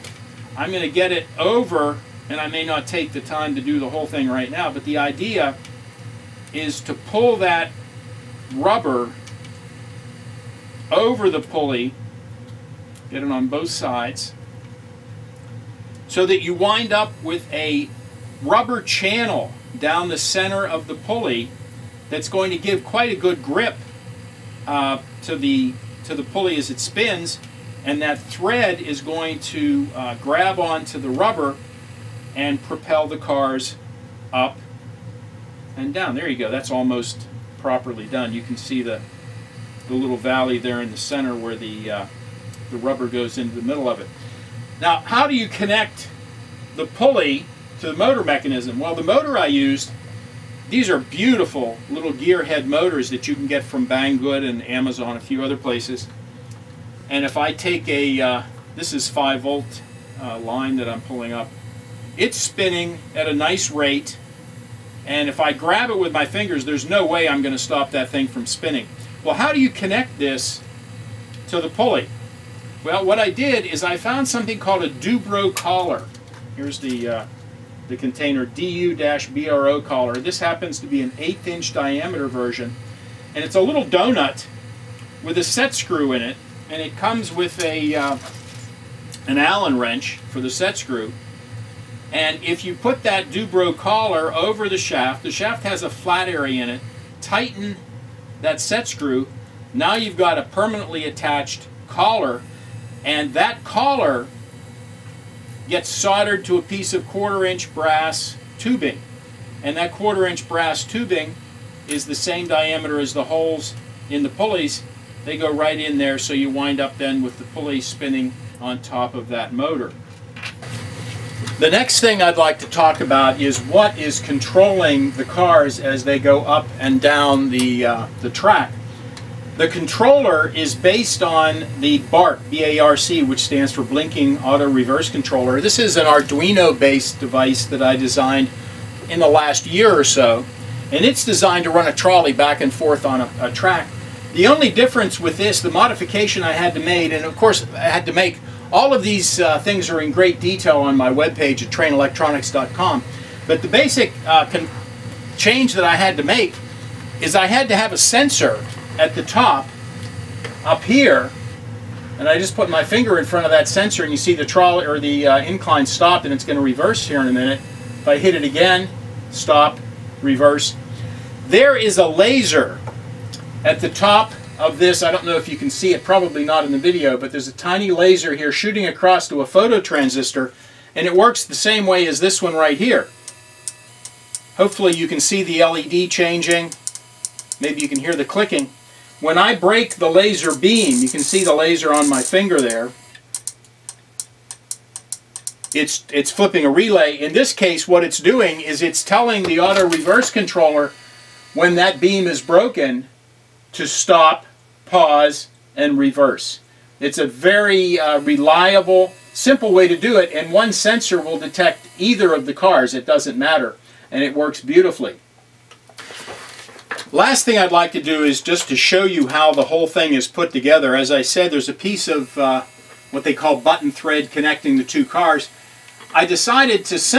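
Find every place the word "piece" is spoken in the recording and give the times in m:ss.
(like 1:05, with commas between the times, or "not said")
1:46, 3:41.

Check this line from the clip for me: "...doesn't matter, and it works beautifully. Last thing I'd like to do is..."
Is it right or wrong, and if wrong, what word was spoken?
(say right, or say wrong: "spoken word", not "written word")
right.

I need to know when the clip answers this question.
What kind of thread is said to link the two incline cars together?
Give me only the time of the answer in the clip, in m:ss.
3:43.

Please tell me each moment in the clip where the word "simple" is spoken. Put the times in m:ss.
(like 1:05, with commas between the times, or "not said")
3:29.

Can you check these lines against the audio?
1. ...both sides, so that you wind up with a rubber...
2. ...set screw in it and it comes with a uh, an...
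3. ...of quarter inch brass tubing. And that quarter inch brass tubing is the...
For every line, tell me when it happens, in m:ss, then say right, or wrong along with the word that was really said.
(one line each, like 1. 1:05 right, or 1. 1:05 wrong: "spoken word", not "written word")
1. 0:13 right
2. 1:25 right
3. 1:46 right.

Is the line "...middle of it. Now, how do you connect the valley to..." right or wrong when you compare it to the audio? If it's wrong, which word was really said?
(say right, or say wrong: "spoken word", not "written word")
wrong: "pulley", not "valley".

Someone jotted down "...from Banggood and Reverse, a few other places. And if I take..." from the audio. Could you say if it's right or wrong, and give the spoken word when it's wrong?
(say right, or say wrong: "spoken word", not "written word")
wrong: "Amazon", not "Reverse".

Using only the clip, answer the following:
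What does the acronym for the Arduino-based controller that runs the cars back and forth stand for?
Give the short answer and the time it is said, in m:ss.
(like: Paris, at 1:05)
Blinking Auto Reverse Controller, at 2:13.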